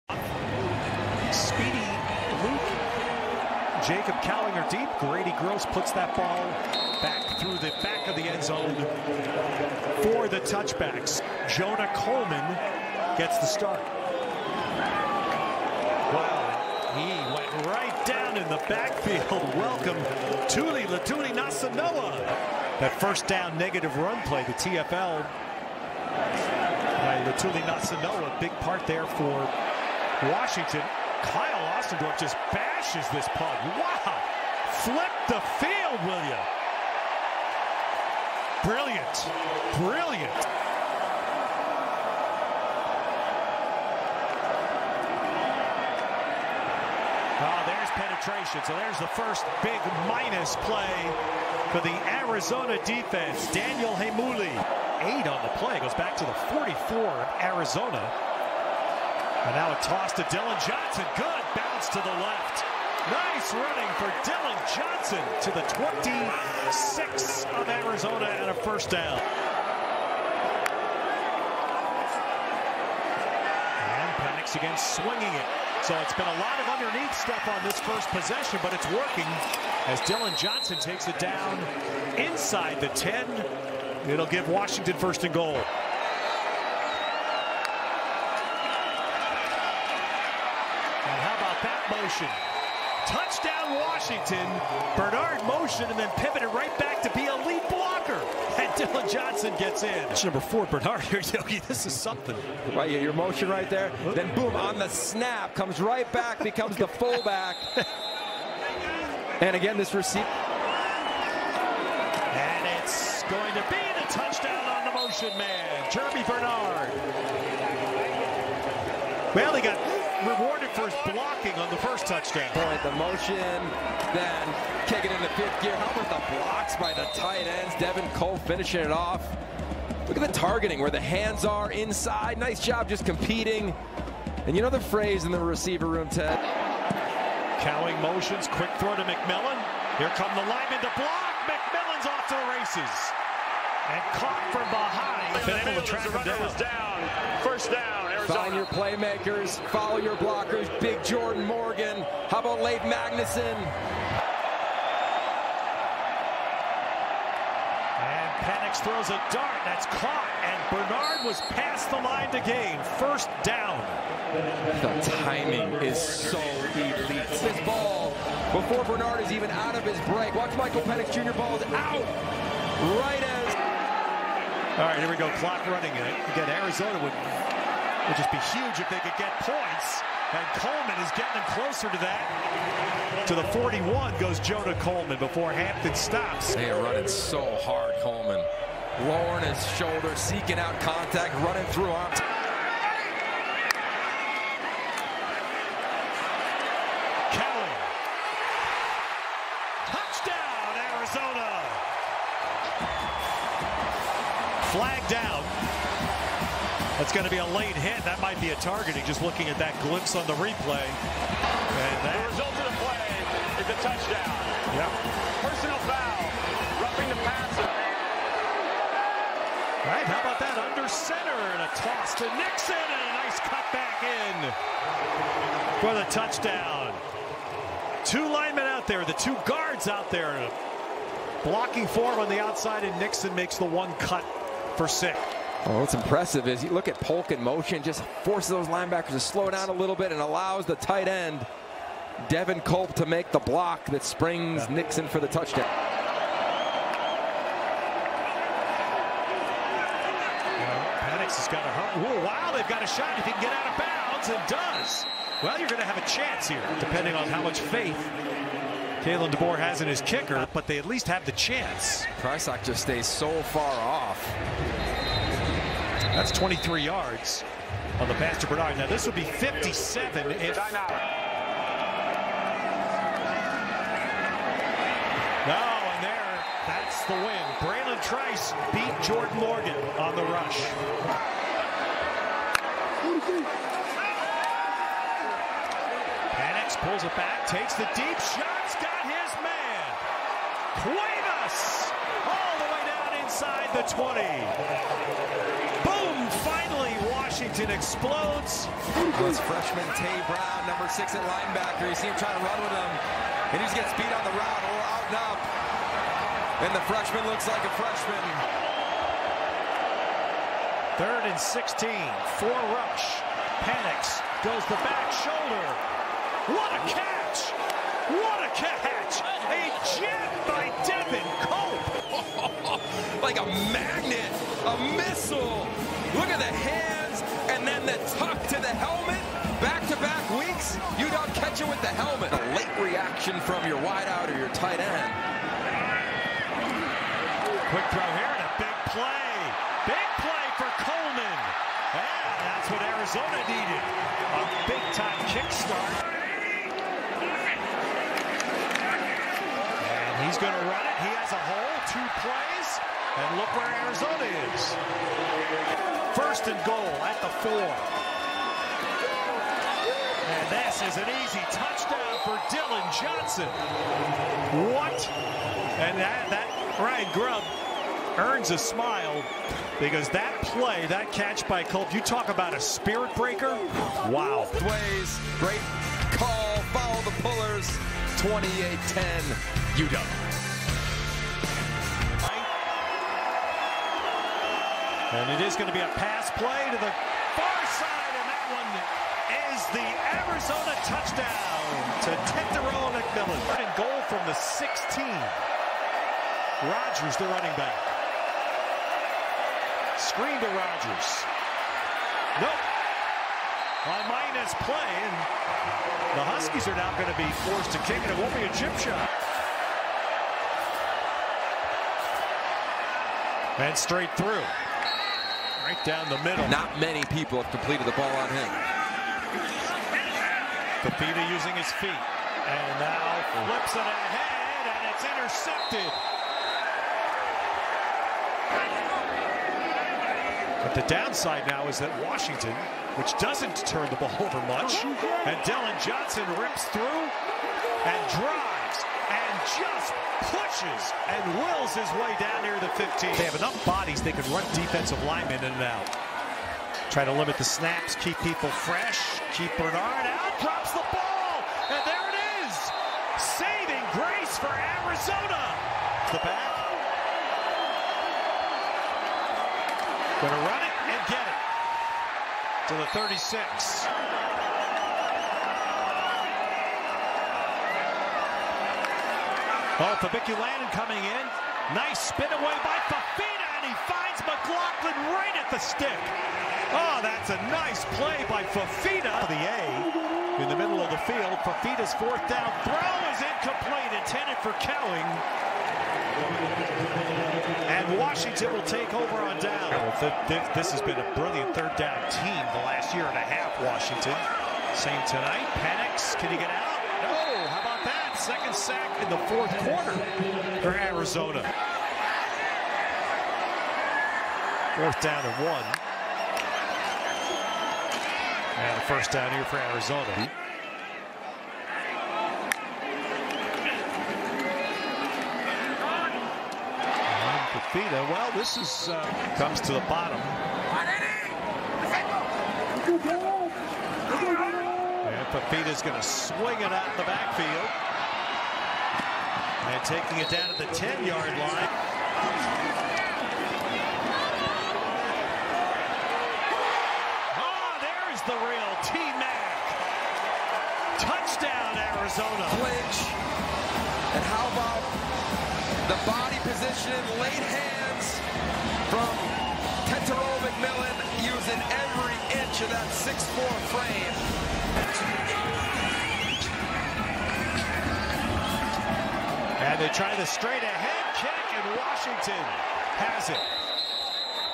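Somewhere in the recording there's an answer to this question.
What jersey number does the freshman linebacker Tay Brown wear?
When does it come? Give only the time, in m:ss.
5:00.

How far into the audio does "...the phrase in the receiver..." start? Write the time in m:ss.
2:14.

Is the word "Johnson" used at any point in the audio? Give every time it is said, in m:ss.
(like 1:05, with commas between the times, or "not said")
1:00, 1:04, 1:20, 1:39, 6:02, 7:15.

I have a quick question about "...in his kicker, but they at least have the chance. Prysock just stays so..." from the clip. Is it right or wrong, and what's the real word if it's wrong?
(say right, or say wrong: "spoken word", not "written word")
right.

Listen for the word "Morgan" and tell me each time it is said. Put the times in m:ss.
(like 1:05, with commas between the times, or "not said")
2:31, 4:39.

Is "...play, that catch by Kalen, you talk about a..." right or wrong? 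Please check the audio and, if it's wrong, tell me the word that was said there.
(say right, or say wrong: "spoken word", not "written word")
wrong: "Culp", not "Kalen".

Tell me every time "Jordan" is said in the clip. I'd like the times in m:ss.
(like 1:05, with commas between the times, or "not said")
2:31, 4:39.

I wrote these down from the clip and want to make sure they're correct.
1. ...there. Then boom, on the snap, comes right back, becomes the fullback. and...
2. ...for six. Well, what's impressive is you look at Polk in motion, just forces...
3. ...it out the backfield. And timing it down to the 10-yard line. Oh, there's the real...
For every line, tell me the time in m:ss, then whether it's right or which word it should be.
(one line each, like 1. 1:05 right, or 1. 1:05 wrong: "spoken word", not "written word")
1. 1:43 right
2. 3:54 right
3. 8:46 wrong: "taking", not "timing".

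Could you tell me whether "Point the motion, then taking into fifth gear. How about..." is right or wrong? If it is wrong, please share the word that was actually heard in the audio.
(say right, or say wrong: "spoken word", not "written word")
wrong: "kicking", not "taking".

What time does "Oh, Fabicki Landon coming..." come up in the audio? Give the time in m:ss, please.
7:49.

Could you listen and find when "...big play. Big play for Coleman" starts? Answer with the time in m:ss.
5:38.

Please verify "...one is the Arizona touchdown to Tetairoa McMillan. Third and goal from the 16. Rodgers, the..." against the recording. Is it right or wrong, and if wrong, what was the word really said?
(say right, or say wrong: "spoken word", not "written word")
right.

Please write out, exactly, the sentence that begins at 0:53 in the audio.
Daniel Heimuli, eight on the play, goes back to the 44 of Arizona.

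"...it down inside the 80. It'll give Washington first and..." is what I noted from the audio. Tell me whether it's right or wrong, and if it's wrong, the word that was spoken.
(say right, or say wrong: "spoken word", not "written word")
wrong: "10", not "80".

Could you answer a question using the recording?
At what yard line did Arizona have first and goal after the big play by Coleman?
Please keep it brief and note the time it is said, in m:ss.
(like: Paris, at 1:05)
4, at 5:57.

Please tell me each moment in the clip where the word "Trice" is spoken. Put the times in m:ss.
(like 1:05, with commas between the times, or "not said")
4:38.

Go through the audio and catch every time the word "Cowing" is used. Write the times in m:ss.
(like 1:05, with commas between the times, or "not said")
2:17, 8:04.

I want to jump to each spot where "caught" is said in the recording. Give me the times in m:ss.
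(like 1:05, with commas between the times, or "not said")
2:24, 2:39.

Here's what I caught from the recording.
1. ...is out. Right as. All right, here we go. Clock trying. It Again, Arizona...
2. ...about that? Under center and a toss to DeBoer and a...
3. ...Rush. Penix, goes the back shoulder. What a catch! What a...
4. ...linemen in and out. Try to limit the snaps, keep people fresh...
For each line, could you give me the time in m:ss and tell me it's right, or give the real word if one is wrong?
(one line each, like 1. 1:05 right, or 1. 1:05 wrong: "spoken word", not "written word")
1. 2:51 wrong: "running", not "trying"
2. 3:40 wrong: "Nixon", not "DeBoer"
3. 5:12 right
4. 7:25 right.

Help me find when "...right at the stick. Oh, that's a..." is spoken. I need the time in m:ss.
7:55.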